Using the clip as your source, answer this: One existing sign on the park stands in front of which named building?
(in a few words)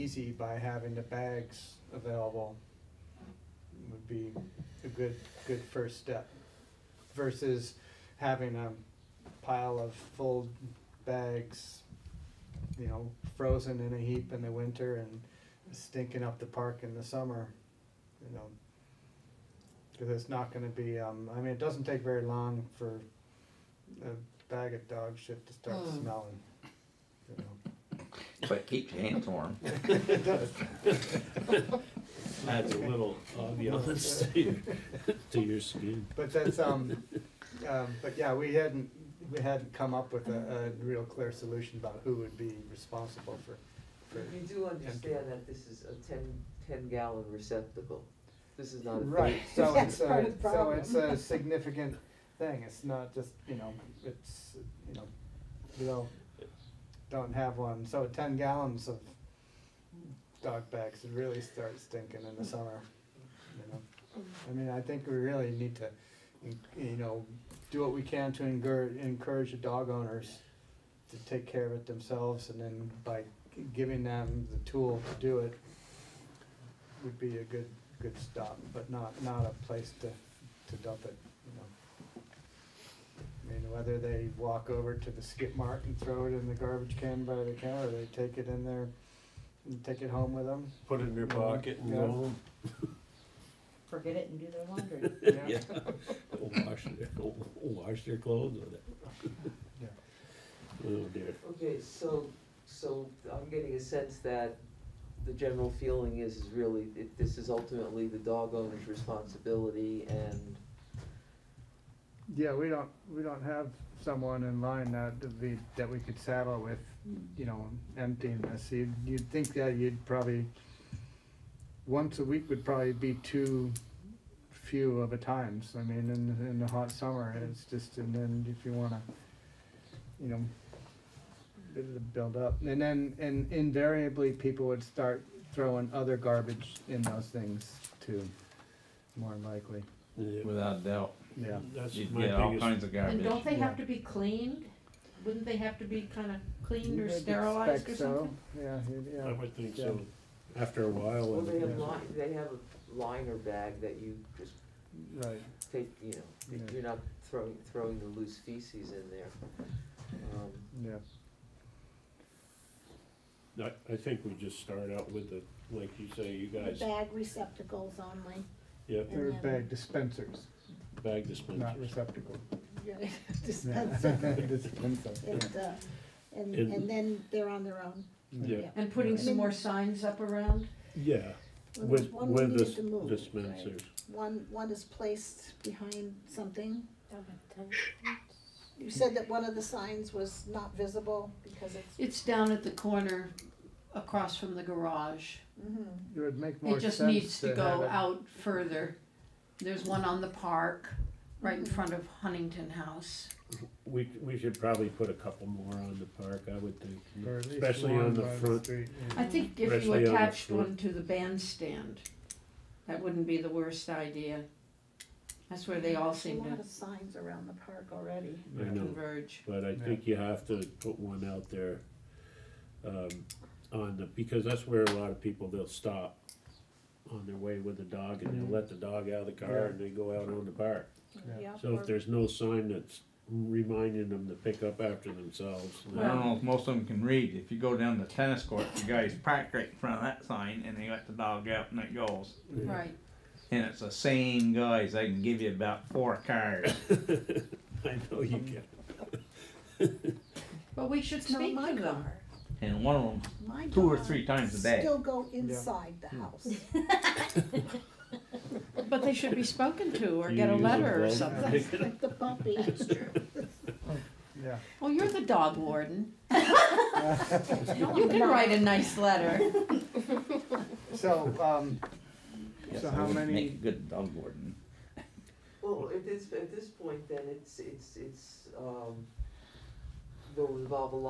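Huntington House.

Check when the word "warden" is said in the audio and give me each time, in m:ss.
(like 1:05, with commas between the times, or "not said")
4:25, 4:34.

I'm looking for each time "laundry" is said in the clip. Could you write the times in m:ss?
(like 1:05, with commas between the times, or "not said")
1:34.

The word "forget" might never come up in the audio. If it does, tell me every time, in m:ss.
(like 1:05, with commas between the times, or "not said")
1:33.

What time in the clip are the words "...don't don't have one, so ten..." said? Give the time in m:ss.
0:55.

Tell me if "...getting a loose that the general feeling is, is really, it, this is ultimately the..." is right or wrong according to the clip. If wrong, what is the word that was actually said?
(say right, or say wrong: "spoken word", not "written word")
wrong: "sense", not "loose".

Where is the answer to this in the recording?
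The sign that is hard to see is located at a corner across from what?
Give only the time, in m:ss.
3:14.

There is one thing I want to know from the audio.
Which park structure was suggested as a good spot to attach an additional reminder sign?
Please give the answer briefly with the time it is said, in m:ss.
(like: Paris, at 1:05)
the bandstand, at 3:30.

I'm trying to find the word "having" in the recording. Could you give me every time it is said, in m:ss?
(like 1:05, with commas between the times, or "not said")
0:00, 0:08.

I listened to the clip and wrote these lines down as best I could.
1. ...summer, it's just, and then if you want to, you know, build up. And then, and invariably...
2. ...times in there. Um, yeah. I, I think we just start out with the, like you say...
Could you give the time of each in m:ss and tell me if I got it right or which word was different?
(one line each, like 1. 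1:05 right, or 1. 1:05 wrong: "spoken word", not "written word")
1. 2:06 right
2. 2:38 wrong: "feces", not "times".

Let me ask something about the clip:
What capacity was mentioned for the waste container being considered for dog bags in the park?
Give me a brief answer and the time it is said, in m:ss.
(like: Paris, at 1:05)
10 gallons, at 0:46.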